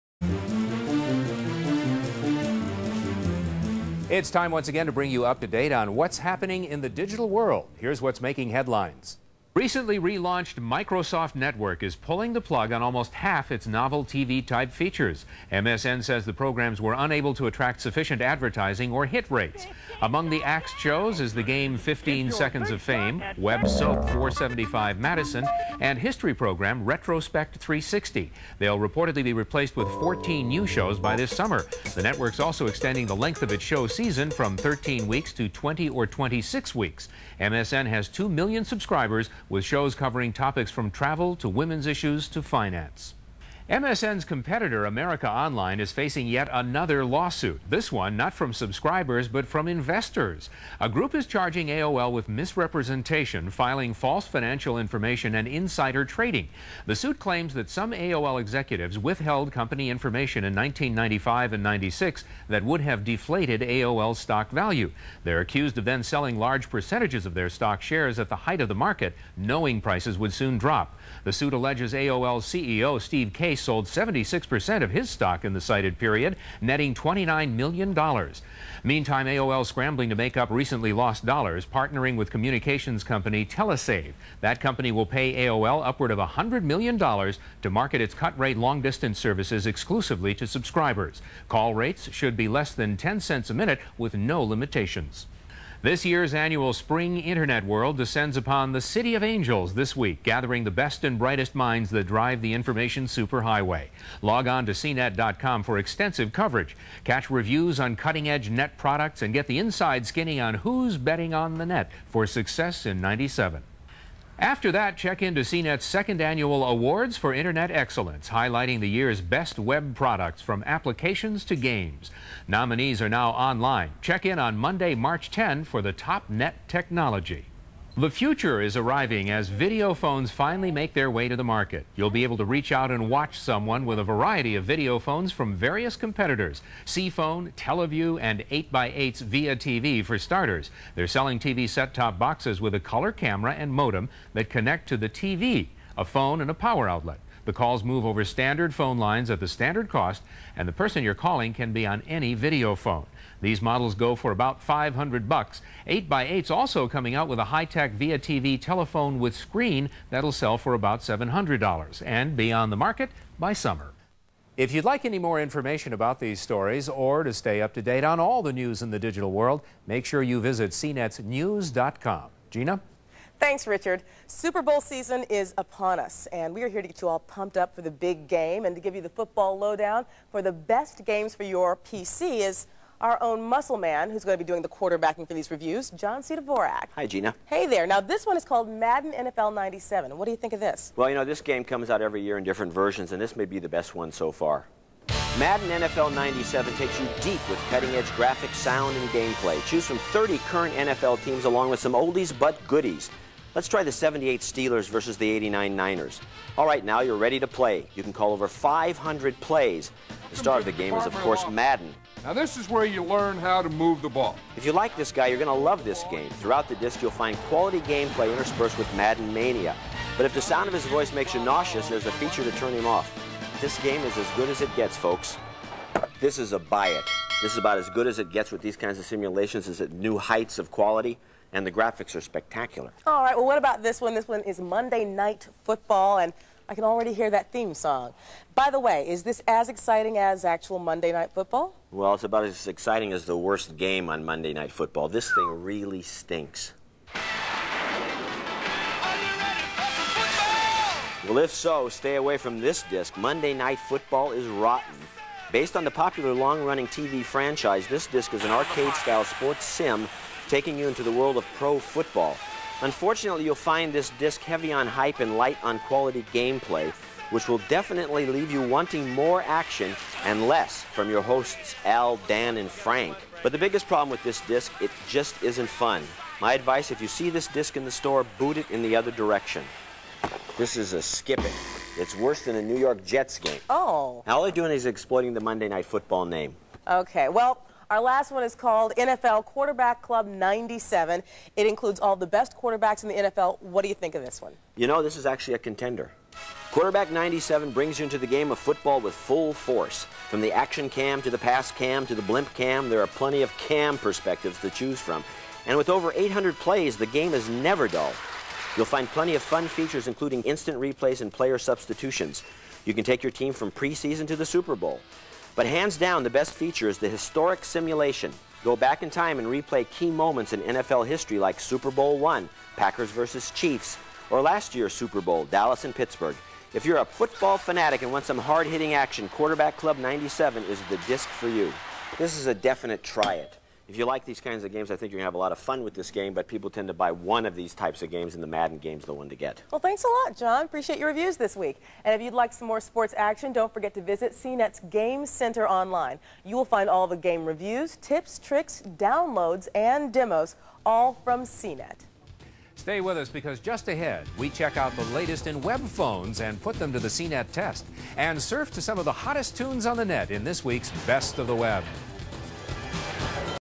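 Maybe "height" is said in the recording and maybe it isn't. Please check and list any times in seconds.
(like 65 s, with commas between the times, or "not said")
68 s, 230 s.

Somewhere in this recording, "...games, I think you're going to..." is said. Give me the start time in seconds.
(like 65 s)
334 s.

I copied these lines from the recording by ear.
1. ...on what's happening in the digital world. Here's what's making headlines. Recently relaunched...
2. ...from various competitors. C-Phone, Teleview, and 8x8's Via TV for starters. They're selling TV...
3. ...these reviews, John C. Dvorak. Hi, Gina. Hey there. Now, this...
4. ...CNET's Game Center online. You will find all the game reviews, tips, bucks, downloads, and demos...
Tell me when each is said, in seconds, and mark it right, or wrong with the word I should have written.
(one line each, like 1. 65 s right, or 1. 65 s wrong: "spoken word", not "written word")
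1. 5 s right
2. 135 s right
3. 185 s right
4. 344 s wrong: "tricks", not "bucks".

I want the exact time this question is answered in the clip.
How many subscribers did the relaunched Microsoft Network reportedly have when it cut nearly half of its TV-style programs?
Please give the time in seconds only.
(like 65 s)
38 s.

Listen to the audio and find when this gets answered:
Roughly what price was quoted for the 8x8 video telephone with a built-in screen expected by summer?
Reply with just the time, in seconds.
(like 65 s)
160 s.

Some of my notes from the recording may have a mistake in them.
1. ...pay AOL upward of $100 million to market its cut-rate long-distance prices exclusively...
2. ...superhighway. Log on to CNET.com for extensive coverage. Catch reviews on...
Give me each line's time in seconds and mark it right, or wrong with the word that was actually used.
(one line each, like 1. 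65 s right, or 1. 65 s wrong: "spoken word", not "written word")
1. 85 s wrong: "services", not "prices"
2. 103 s right.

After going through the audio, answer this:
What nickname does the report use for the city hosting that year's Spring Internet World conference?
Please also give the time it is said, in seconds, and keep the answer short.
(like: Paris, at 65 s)
City of Angels, at 98 s.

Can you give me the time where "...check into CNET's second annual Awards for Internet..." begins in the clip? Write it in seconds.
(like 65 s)
114 s.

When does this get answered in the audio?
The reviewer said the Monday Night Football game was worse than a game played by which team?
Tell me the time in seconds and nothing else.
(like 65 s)
282 s.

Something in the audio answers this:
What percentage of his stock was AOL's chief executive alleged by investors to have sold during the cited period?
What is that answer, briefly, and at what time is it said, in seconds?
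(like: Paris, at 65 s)
76%, at 73 s.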